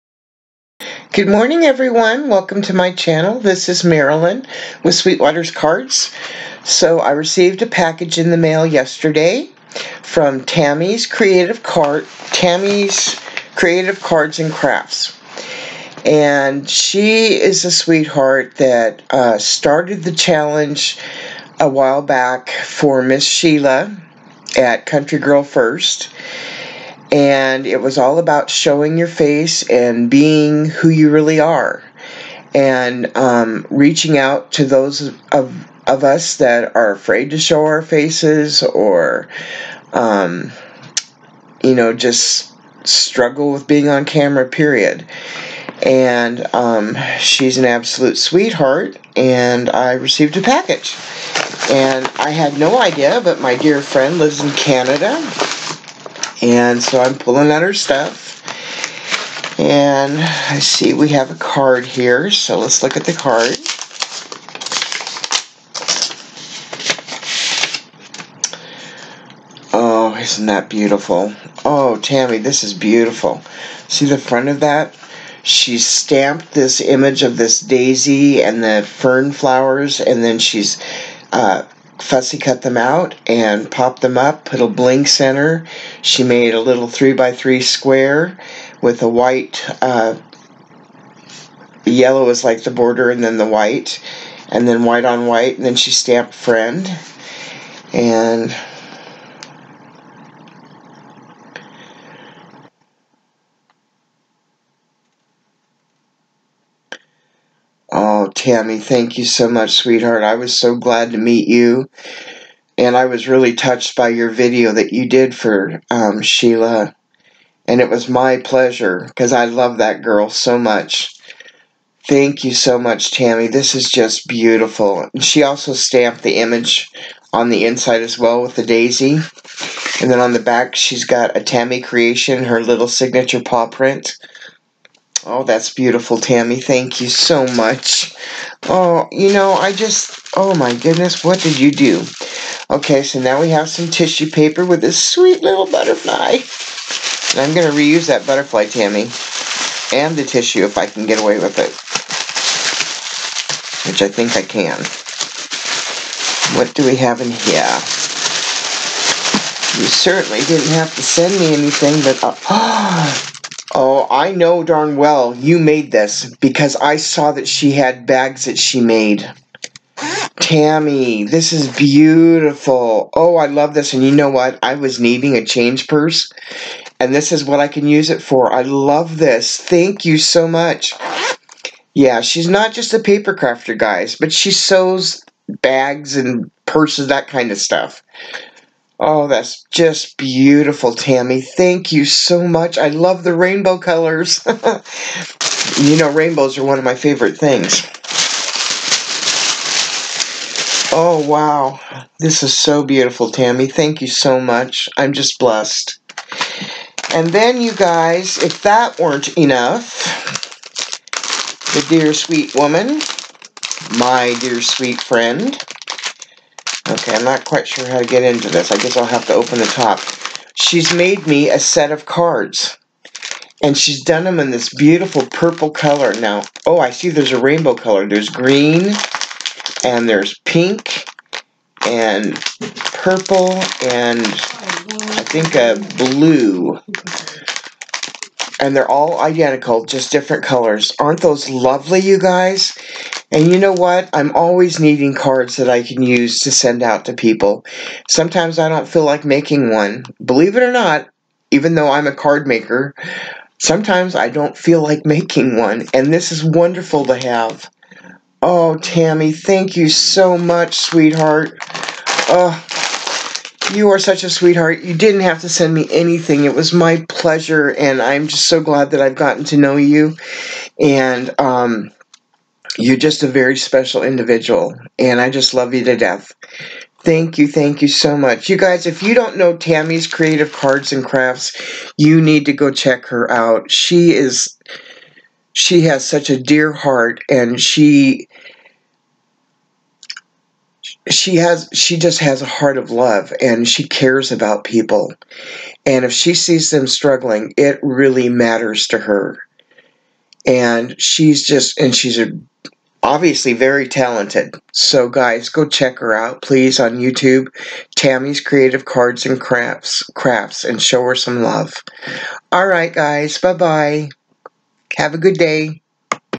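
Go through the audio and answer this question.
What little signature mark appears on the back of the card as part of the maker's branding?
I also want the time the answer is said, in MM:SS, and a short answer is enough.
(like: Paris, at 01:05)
paw print, at 02:13.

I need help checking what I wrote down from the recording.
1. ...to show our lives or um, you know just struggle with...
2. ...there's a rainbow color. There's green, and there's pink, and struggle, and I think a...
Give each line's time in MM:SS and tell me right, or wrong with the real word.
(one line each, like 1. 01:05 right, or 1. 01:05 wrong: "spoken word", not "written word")
1. 00:37 wrong: "faces", not "lives"
2. 03:47 wrong: "purple", not "struggle".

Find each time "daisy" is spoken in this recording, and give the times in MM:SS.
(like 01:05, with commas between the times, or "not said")
01:17, 02:08.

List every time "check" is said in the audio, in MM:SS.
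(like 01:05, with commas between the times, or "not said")
04:42, 05:05.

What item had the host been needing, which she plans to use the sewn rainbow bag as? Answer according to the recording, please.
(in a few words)
change purse.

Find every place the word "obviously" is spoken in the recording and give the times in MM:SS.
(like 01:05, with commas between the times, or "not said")
05:03.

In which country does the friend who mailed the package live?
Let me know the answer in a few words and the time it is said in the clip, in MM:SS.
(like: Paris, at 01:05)
Canada, at 00:54.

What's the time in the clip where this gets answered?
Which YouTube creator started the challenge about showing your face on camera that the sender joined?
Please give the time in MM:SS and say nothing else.
00:24.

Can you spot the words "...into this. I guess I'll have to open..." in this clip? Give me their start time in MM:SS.
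03:38.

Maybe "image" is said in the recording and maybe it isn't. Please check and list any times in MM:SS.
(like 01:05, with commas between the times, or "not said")
01:16, 02:06.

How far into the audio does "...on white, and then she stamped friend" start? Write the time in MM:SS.
01:35.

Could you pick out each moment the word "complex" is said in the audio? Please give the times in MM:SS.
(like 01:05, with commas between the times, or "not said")
not said.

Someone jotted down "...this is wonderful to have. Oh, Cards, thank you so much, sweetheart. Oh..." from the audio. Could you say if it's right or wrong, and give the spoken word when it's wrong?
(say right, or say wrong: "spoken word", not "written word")
wrong: "Tammy", not "Cards".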